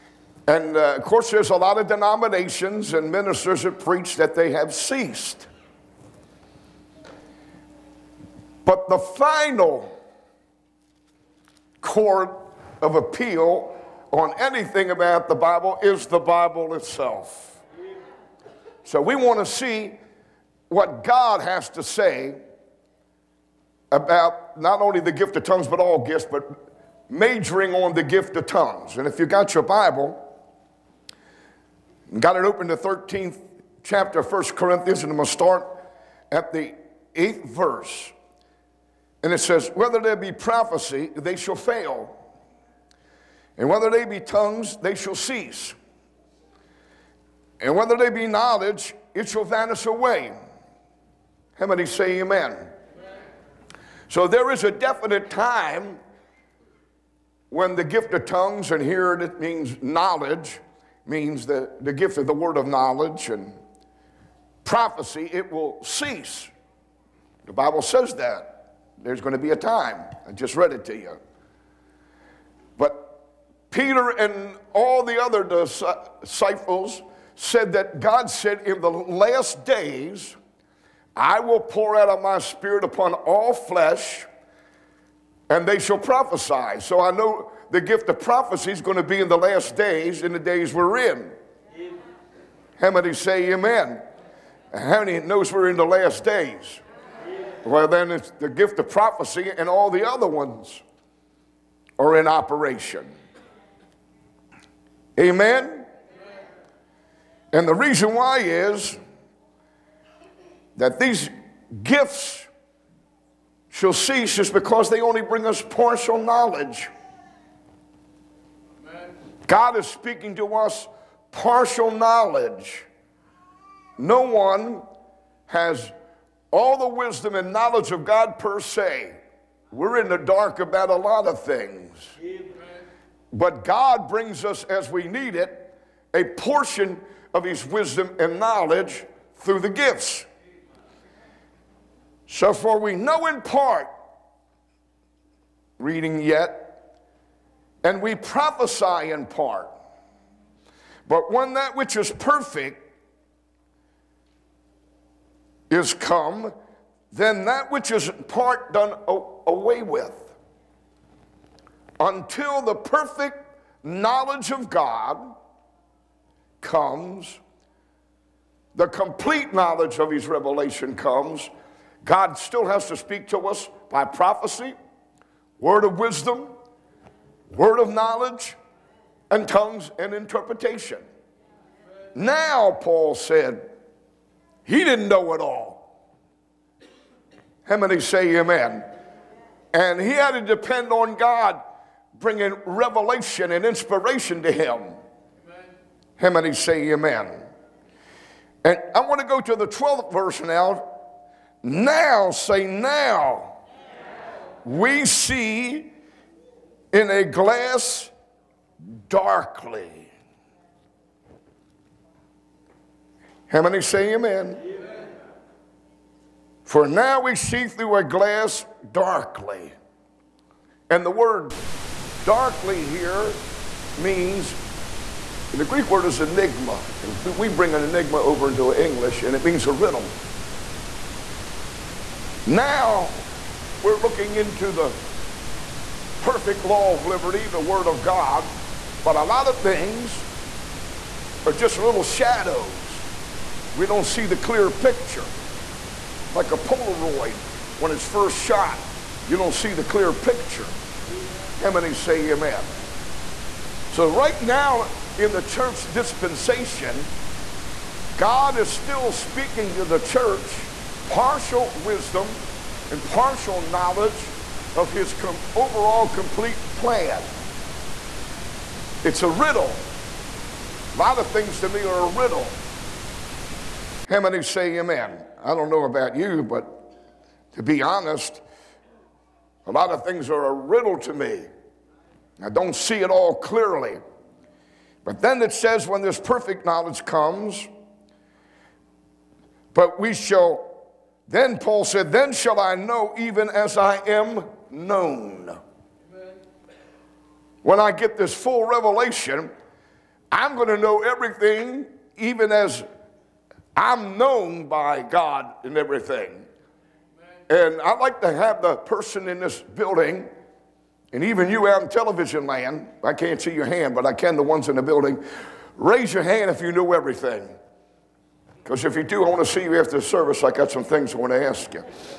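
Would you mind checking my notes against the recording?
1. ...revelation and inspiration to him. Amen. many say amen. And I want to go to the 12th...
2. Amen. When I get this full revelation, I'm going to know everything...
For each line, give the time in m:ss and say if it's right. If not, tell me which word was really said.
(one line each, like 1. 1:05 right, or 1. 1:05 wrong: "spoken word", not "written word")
1. 3:12 right
2. 4:56 right.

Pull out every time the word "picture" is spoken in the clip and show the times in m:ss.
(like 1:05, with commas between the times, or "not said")
4:04, 4:10.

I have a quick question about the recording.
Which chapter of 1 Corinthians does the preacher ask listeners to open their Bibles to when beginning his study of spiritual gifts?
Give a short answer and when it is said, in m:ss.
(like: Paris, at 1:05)
13th, at 0:32.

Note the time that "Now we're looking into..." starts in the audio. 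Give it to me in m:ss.
3:52.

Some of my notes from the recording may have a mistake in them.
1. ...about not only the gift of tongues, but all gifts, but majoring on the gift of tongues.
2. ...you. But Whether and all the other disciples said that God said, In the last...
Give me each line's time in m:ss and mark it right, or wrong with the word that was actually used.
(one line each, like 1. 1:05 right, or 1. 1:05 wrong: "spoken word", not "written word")
1. 0:23 right
2. 1:10 wrong: "Peter", not "Whether".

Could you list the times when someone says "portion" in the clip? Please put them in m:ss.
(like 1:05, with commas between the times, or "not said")
2:16.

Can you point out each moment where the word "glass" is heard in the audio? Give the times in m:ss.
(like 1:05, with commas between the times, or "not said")
3:27, 3:38.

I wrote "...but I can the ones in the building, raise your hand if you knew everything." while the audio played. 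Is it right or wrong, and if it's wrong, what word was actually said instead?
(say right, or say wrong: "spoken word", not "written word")
right.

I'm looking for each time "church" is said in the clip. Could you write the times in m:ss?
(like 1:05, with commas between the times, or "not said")
4:15, 4:19.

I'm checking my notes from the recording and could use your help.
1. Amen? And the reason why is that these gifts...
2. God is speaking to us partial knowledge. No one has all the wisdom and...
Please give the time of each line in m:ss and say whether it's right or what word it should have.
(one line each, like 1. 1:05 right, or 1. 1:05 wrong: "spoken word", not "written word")
1. 1:45 right
2. 1:59 right.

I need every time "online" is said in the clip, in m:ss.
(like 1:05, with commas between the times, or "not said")
not said.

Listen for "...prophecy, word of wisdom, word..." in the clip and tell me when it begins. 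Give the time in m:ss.
2:54.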